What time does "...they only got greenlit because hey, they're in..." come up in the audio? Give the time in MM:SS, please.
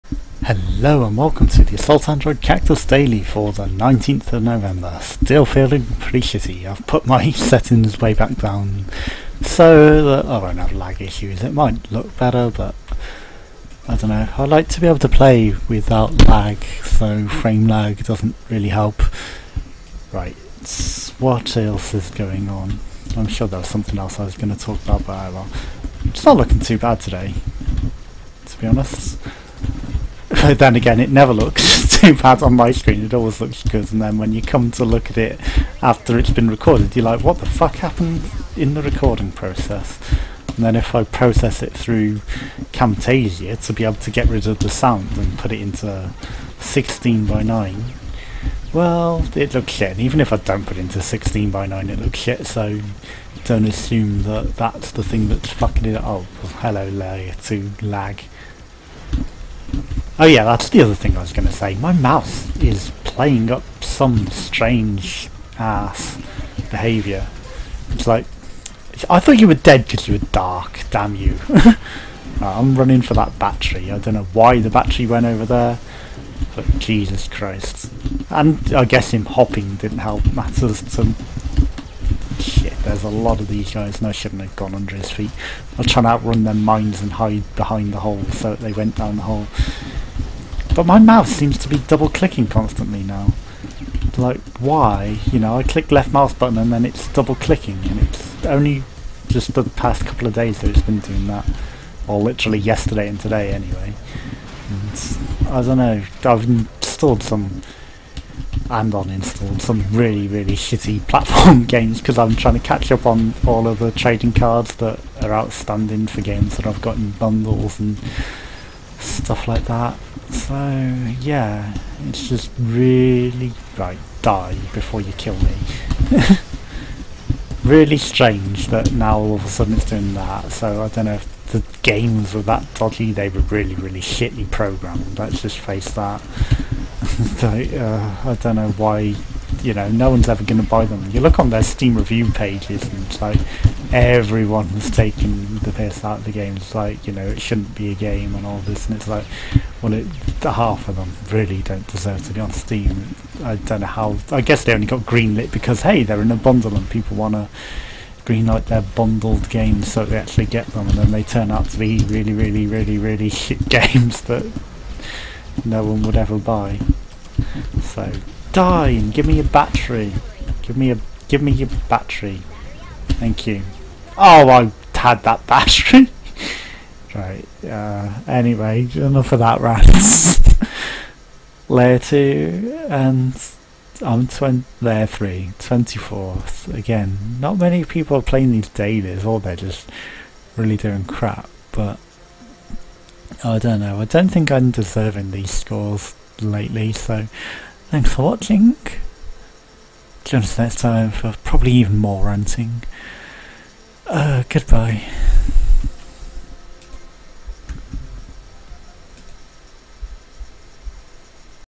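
02:34.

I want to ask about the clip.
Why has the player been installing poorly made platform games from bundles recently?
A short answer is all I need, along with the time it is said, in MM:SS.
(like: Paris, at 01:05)
trading cards, at 01:53.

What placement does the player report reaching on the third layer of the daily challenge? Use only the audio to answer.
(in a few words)
24th.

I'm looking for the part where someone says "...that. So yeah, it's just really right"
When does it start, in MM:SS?
01:59.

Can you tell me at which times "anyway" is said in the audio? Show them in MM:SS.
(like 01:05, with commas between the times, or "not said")
01:43, 02:58.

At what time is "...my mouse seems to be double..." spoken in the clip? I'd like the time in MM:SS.
01:30.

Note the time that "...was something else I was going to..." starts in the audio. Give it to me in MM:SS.
00:23.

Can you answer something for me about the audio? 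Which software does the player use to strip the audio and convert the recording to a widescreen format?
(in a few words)
Camtasia.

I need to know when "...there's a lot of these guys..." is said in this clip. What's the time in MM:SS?
01:22.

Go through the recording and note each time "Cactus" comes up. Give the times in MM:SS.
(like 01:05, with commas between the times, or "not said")
00:02.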